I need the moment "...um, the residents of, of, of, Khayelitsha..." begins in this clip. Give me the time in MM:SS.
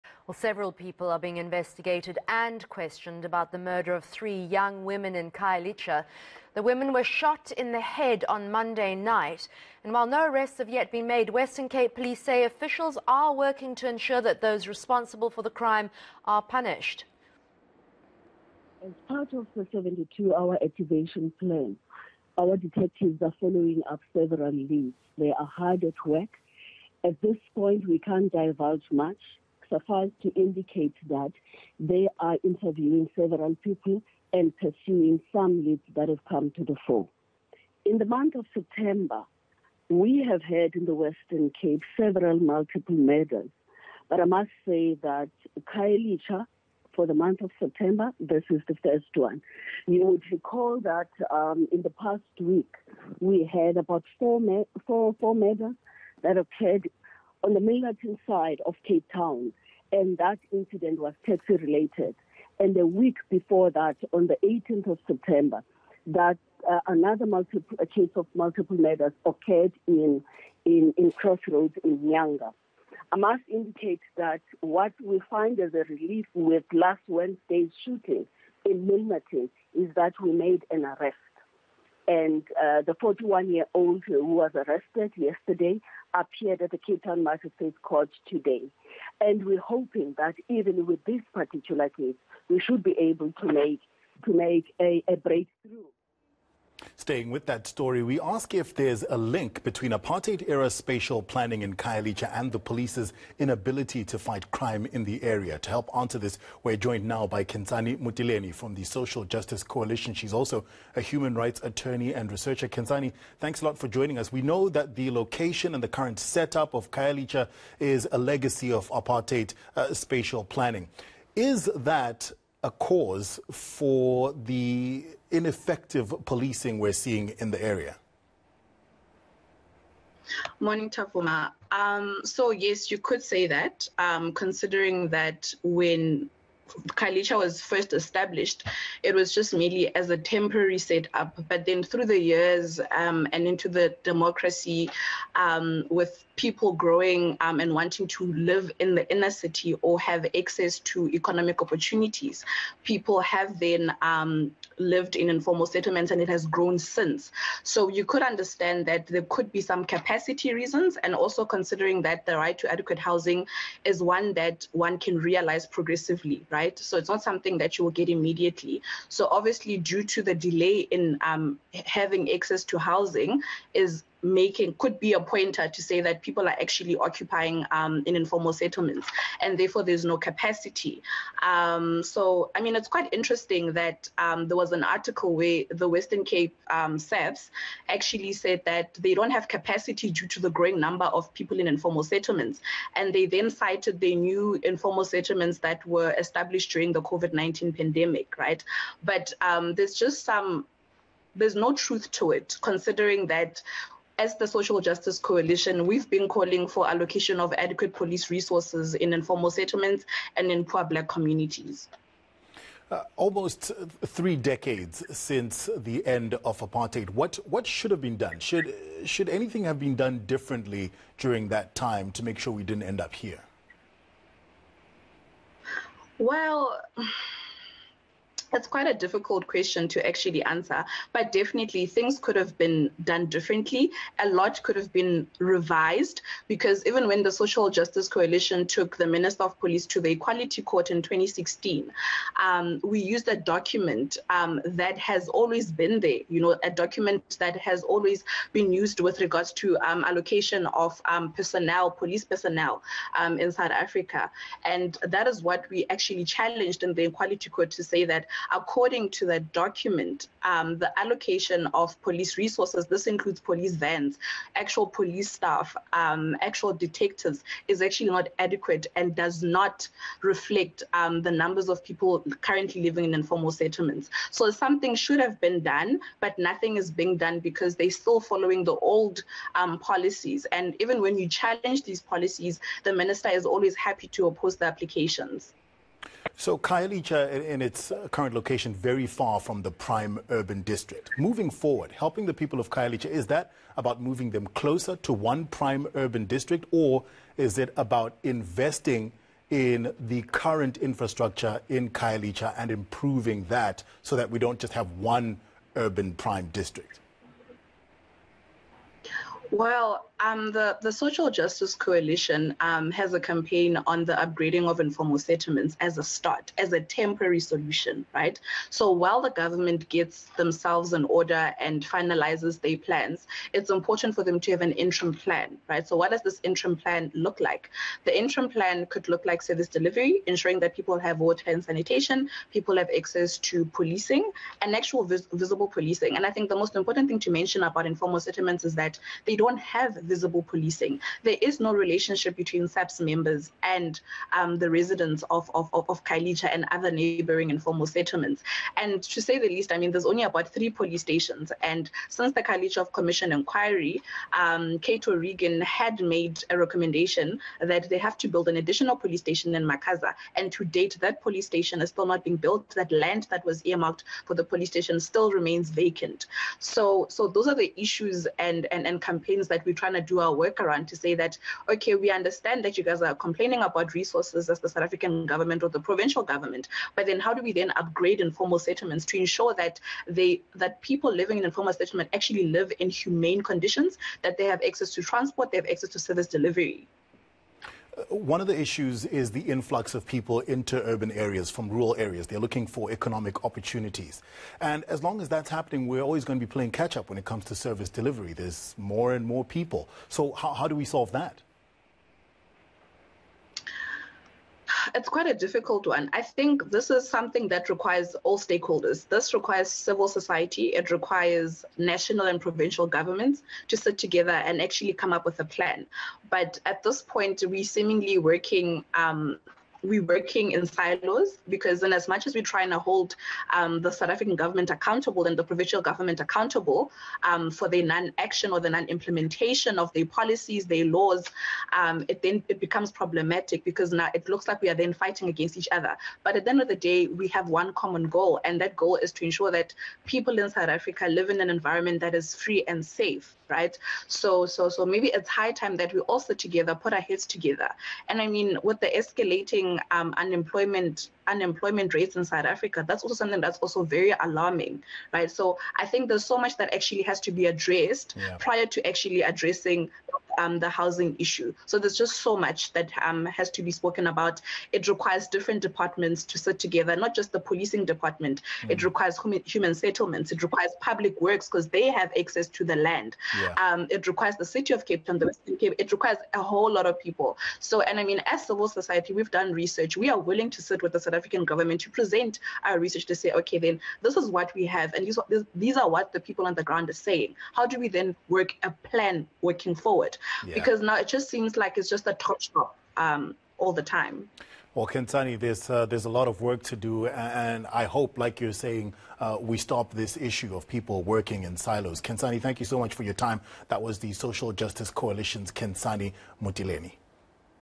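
05:44.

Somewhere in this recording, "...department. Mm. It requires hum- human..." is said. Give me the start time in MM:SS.
07:47.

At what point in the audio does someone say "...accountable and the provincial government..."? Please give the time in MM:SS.
07:04.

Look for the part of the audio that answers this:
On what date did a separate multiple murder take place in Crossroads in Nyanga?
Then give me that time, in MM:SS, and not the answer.
01:04.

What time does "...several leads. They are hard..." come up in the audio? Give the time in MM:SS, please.
00:24.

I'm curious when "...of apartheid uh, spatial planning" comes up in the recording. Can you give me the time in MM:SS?
01:58.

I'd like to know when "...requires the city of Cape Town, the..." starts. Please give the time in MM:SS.
07:54.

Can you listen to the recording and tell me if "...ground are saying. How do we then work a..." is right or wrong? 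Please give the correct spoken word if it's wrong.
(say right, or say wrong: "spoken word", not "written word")
right.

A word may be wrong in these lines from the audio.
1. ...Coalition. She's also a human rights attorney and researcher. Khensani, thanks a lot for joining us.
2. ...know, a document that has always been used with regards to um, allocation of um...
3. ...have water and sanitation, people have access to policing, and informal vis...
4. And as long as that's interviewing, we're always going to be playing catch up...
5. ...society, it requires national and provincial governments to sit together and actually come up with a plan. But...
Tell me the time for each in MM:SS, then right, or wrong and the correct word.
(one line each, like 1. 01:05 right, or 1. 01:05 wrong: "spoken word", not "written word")
1. 01:49 right
2. 04:06 right
3. 05:30 wrong: "actual", not "informal"
4. 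06:34 wrong: "happening", not "interviewing"
5. 06:50 right.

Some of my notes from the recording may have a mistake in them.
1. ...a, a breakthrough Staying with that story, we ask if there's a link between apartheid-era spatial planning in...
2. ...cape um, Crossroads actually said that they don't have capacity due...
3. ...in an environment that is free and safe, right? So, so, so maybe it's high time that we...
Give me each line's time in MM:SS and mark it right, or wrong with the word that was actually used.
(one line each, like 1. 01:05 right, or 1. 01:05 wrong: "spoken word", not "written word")
1. 01:34 right
2. 03:06 wrong: "SAPS", not "Crossroads"
3. 07:21 right.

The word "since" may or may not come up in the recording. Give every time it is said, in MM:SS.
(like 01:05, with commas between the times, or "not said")
02:36, 03:35, 05:52.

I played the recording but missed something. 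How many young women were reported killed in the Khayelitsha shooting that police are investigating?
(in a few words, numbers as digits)
3.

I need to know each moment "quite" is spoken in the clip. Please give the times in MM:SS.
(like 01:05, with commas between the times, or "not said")
03:02, 03:48, 06:45.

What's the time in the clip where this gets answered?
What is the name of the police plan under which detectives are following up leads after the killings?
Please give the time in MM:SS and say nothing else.
00:19.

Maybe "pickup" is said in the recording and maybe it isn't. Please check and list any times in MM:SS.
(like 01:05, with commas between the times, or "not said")
not said.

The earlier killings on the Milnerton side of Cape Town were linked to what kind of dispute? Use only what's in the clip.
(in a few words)
Taxi related.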